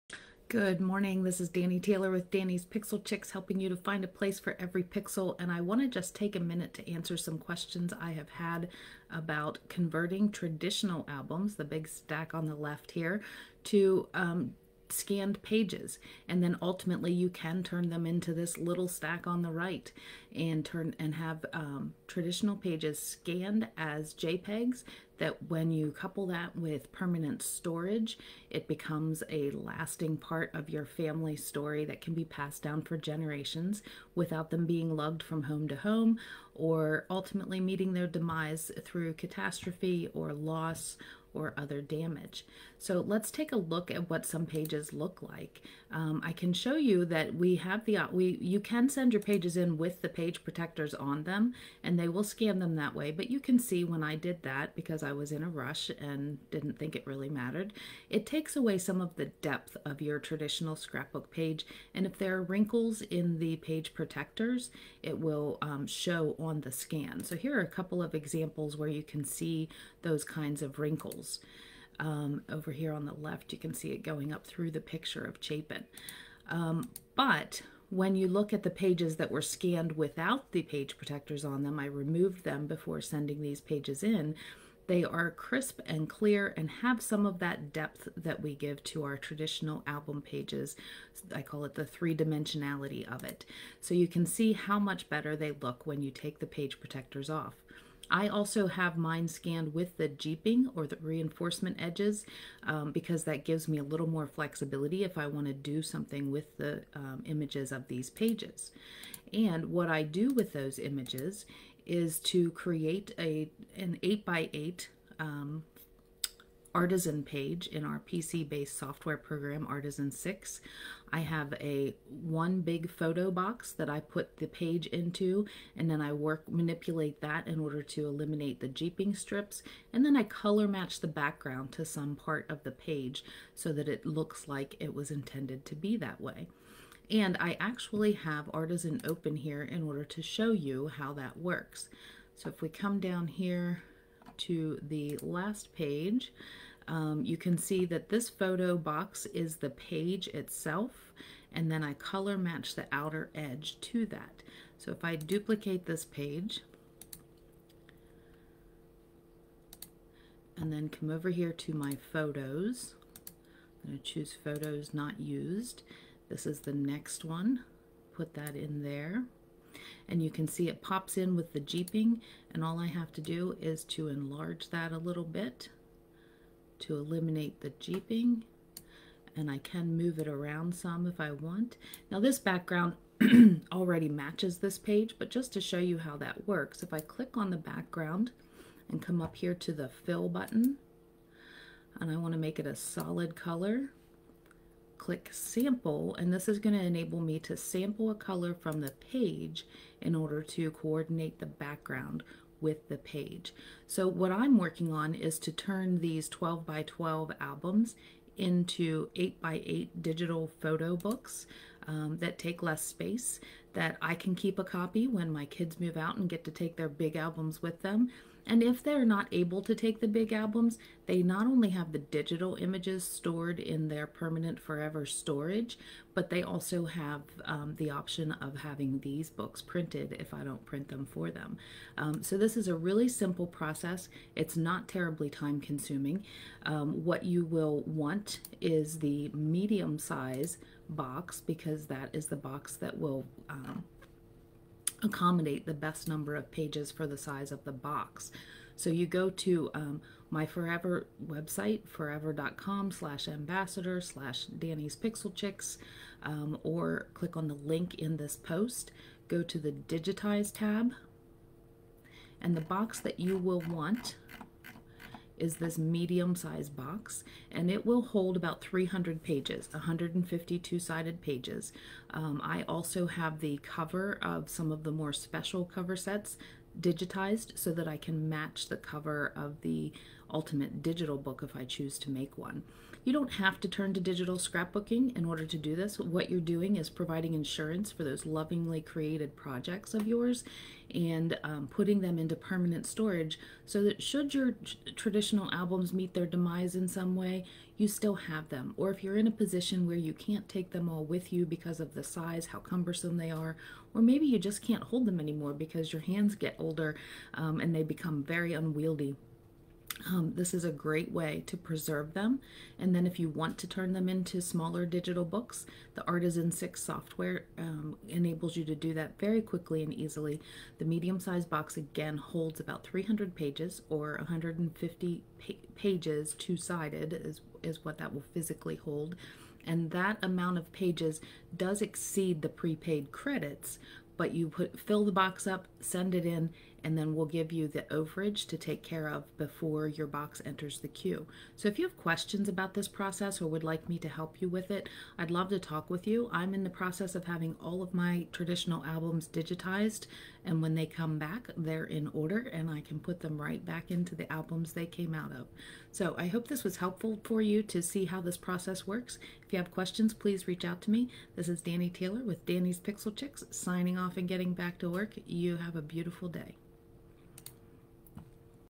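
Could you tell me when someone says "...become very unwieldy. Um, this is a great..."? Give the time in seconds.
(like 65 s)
307 s.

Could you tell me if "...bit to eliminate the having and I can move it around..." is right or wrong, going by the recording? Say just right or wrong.
wrong.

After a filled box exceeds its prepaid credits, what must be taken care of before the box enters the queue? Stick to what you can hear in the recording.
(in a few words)
the overage.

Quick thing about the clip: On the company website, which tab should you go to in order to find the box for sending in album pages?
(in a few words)
Digitize.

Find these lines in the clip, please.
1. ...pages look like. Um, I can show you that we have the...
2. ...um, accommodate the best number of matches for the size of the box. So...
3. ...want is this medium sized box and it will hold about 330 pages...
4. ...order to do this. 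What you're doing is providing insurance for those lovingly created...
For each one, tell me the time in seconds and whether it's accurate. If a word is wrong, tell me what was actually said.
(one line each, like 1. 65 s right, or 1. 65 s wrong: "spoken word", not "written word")
1. 44 s right
2. 243 s wrong: "pages", not "matches"
3. 263 s wrong: "300", not "330"
4. 285 s right.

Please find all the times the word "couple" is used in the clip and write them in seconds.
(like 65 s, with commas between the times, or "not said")
25 s, 67 s.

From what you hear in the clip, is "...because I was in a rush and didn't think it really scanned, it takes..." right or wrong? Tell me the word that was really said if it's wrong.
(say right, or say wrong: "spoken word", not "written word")
wrong: "mattered", not "scanned".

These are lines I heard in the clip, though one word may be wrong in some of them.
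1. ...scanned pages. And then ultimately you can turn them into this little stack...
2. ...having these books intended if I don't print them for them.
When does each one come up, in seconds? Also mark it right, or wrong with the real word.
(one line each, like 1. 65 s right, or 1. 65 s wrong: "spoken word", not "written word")
1. 14 s right
2. 228 s wrong: "printed", not "intended".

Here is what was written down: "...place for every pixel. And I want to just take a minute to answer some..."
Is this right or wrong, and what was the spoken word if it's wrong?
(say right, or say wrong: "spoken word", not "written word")
right.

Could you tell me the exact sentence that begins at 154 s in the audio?
So if I duplicate this page, and then come over here to my photos, I'm going to choose photos not used.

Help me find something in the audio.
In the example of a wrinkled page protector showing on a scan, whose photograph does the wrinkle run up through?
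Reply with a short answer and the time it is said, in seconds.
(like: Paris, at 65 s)
Chapin, at 75 s.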